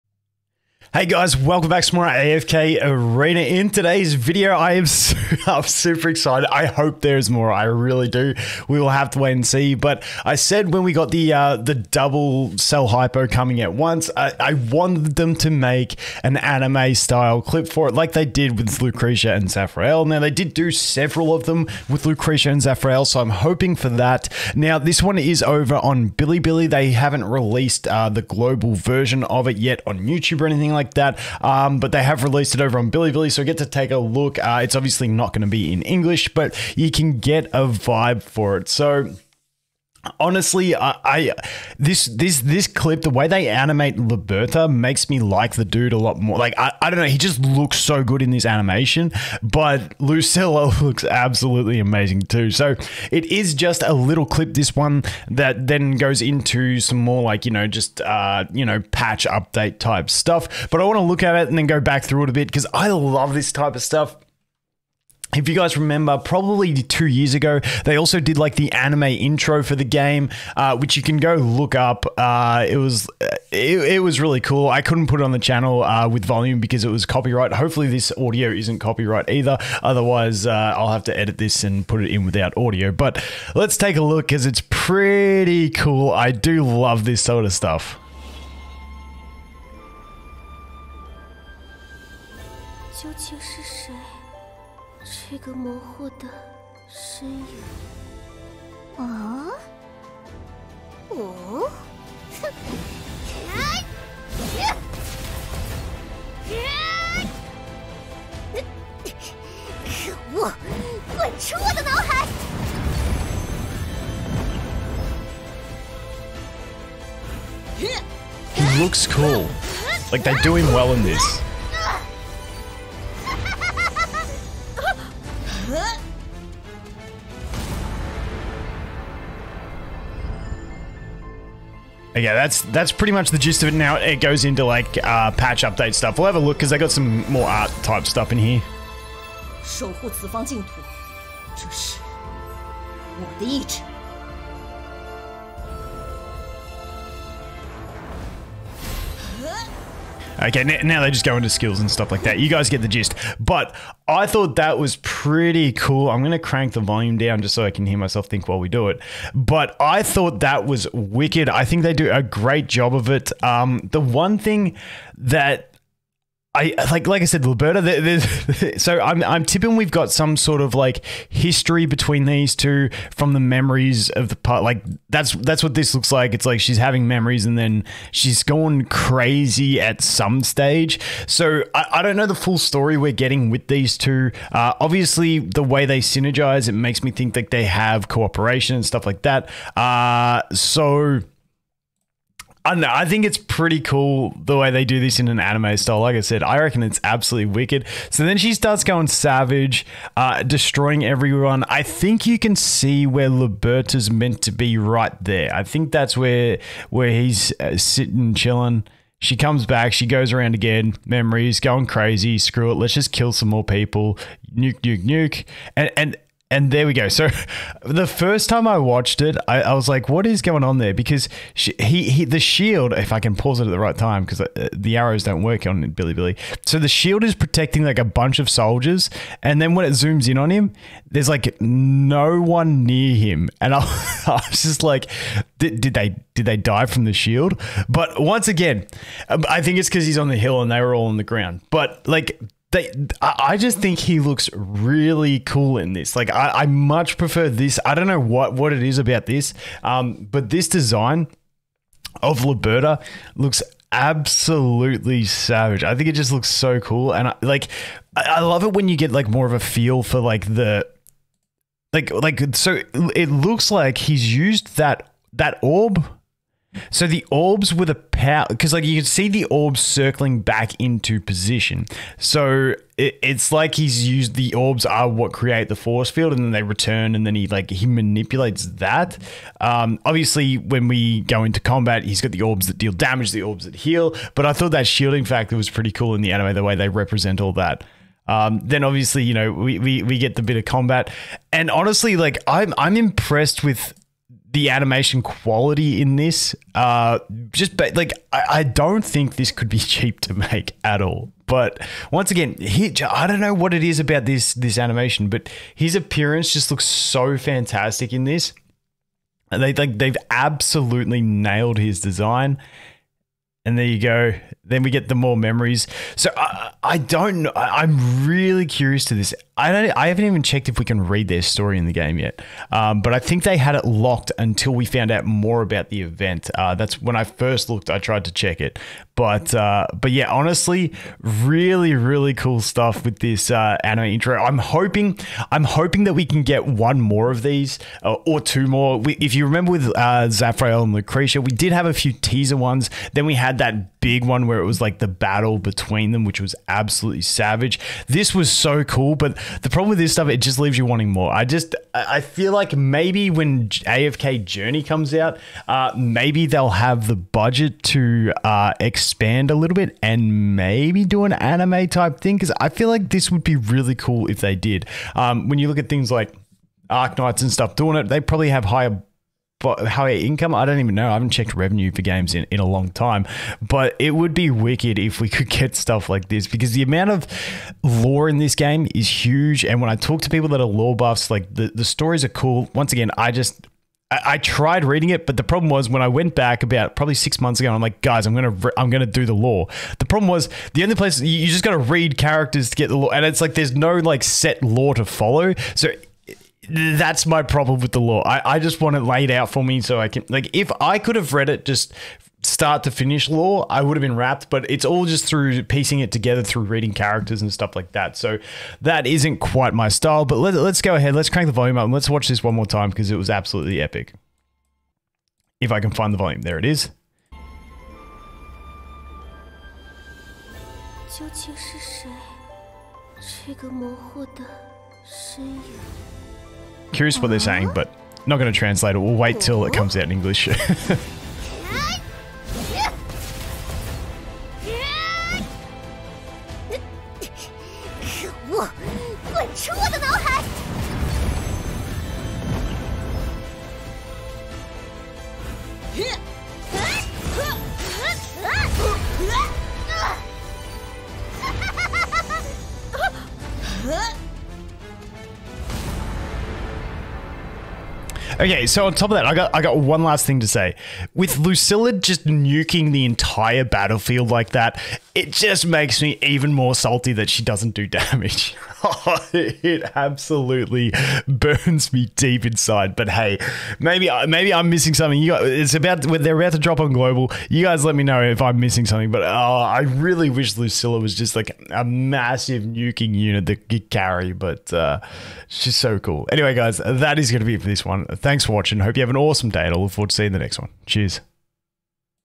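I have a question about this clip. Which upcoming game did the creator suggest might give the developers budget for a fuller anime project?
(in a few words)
AFK Journey.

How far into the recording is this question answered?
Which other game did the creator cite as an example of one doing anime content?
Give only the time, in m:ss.
6:06.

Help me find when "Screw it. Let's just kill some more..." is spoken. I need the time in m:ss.
3:32.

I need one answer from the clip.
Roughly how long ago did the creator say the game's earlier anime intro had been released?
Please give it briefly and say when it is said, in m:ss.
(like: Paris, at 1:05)
2 years ago, at 1:06.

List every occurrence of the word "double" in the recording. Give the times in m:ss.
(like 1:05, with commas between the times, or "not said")
0:11.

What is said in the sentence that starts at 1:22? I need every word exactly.
But let's take a look because it's pretty cool.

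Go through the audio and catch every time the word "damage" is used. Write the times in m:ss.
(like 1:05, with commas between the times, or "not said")
4:42, 7:47.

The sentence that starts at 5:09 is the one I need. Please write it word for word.
They like they've absolutely nailed his design.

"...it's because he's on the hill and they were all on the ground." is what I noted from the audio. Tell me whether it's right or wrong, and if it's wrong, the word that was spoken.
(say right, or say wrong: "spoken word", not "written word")
right.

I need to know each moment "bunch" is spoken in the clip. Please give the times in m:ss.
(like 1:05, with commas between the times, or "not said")
3:48.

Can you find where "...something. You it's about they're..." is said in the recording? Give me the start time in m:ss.
7:54.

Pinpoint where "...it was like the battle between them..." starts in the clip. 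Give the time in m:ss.
5:44.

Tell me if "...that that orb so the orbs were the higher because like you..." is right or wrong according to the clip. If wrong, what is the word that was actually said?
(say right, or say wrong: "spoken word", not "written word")
wrong: "power", not "higher".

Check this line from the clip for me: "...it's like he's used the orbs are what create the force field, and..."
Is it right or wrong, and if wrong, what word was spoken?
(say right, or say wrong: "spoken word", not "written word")
right.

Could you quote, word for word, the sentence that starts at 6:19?
And when I talk to people that are lore buffs, like the, the stories are cool.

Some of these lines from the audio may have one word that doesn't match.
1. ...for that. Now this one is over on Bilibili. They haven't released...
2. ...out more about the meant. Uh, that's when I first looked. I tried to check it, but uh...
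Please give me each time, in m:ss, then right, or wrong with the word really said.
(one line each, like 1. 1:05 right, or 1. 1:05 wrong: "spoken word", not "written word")
1. 0:23 right
2. 5:25 wrong: "event", not "meant".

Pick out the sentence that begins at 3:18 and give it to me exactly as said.
So then she starts going savage, uh, destroying everyone.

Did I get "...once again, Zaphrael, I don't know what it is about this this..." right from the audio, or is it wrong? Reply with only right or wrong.
wrong.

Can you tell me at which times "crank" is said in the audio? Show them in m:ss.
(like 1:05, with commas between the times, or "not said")
2:36, 6:51.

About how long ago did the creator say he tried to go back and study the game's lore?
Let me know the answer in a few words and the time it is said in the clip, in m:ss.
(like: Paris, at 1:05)
6 months ago, at 6:27.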